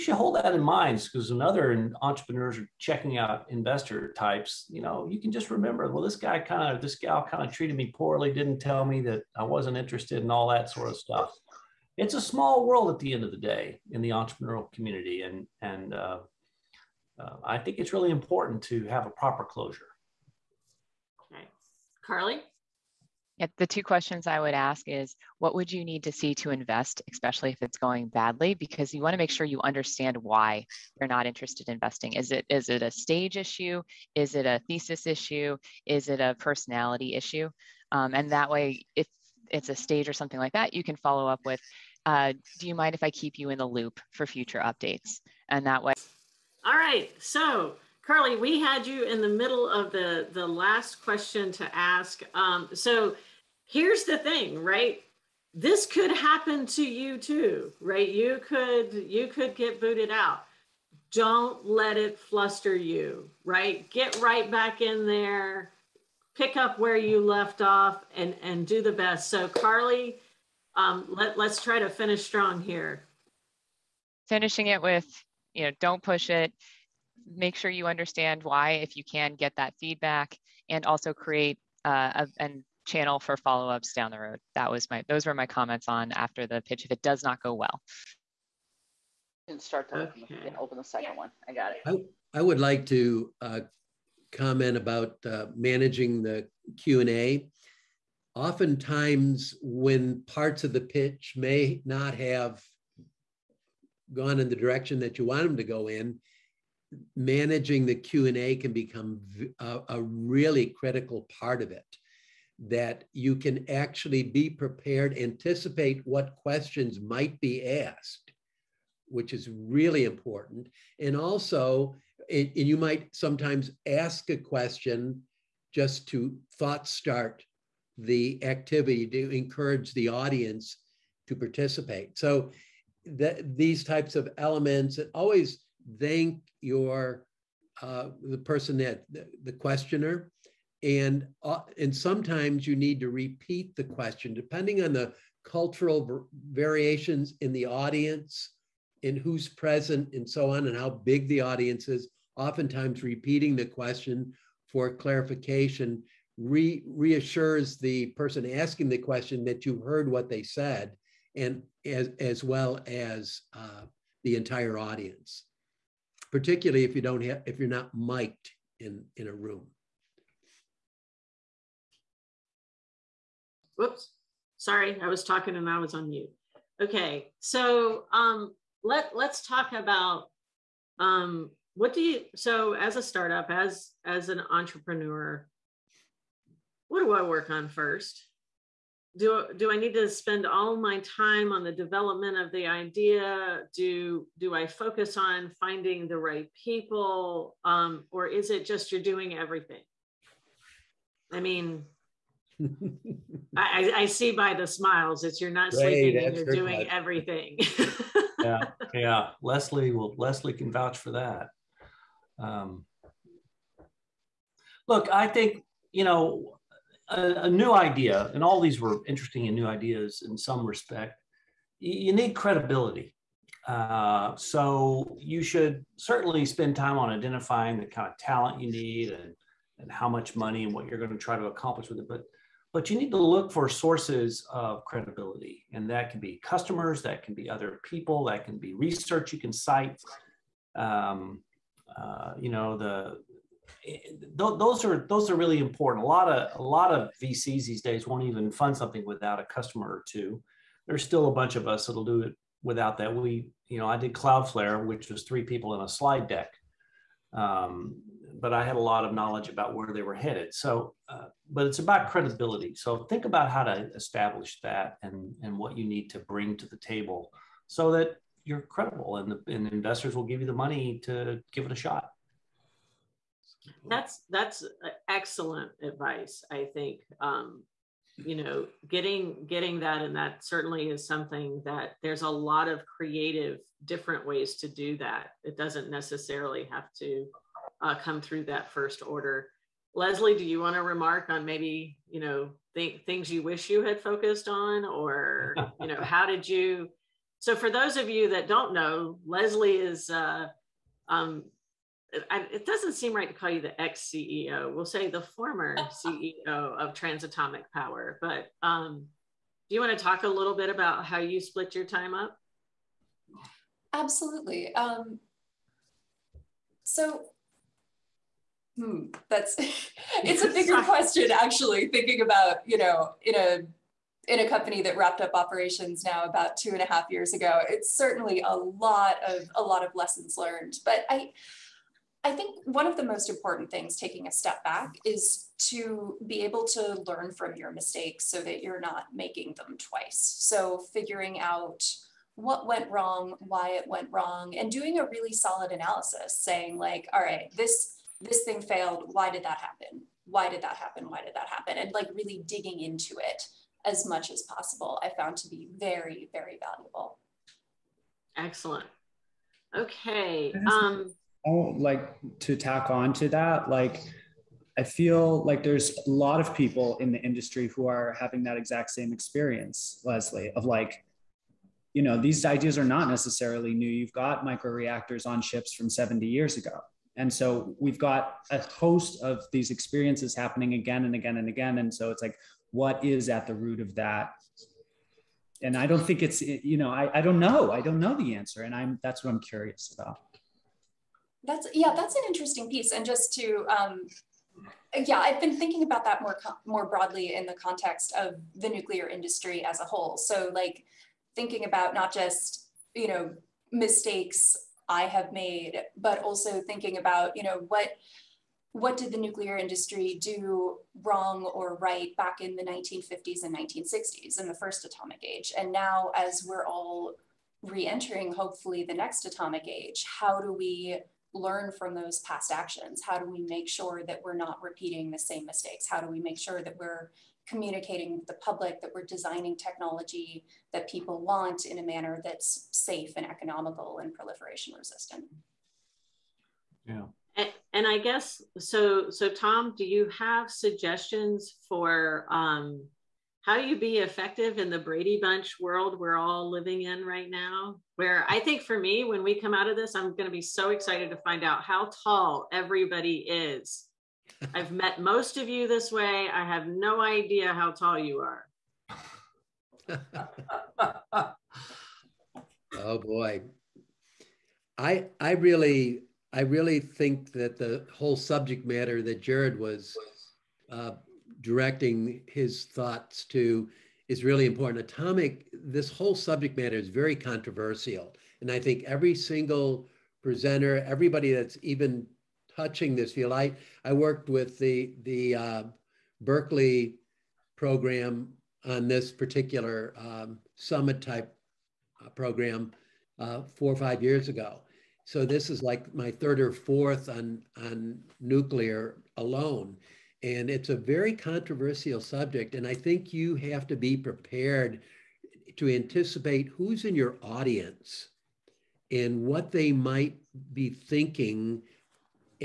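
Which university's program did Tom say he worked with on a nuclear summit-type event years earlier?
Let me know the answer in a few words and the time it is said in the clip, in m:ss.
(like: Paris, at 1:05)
Berkeley, at 8:06.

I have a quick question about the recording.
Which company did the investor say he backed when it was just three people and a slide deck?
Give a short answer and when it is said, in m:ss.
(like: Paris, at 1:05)
Cloudflare, at 4:14.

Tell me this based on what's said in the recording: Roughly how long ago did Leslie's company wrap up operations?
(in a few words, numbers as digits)
2.5 years.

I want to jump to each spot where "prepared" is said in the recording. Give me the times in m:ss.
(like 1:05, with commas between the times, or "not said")
1:54, 8:23.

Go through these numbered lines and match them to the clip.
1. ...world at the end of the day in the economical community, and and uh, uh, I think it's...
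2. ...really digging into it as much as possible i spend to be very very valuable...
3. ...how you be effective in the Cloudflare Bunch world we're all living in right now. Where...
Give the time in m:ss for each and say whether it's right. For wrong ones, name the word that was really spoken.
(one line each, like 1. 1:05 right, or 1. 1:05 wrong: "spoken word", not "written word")
1. 0:12 wrong: "entrepreneurial", not "economical"
2. 5:52 wrong: "found", not "spend"
3. 7:23 wrong: "Brady", not "Cloudflare".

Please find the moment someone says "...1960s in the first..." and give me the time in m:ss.
6:53.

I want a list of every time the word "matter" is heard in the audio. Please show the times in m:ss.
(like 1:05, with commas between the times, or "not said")
7:48, 7:56.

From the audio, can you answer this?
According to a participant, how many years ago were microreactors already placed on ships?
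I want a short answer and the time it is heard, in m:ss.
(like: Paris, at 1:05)
70 years, at 6:15.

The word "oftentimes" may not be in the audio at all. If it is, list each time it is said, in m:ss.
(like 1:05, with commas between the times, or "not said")
1:38, 2:32.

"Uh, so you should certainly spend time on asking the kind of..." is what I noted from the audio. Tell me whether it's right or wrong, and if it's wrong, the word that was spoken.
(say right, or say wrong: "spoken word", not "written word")
wrong: "identifying", not "asking".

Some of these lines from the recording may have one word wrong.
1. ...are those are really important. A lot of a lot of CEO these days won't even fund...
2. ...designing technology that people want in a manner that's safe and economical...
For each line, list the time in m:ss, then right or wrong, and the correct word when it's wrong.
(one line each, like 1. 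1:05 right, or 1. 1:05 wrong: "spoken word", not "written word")
1. 4:04 wrong: "VCs", not "CEO"
2. 7:09 right.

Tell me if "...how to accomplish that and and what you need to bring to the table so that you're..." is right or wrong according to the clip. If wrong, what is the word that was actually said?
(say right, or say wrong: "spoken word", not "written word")
wrong: "establish", not "accomplish".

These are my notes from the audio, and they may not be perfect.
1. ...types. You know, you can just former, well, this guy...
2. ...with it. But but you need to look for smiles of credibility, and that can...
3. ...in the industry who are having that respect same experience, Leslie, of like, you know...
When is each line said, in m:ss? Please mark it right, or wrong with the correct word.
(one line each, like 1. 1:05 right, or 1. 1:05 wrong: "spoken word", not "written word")
1. 0:04 wrong: "remember", not "former"
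2. 3:51 wrong: "sources", not "smiles"
3. 6:06 wrong: "exact", not "respect".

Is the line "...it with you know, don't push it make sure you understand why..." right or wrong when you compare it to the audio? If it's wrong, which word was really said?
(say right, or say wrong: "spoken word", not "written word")
right.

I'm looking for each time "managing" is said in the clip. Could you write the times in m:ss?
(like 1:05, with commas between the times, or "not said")
1:35, 1:47.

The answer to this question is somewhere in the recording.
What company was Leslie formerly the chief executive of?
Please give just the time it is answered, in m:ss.
5:06.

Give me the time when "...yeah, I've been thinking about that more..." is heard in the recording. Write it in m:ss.
6:35.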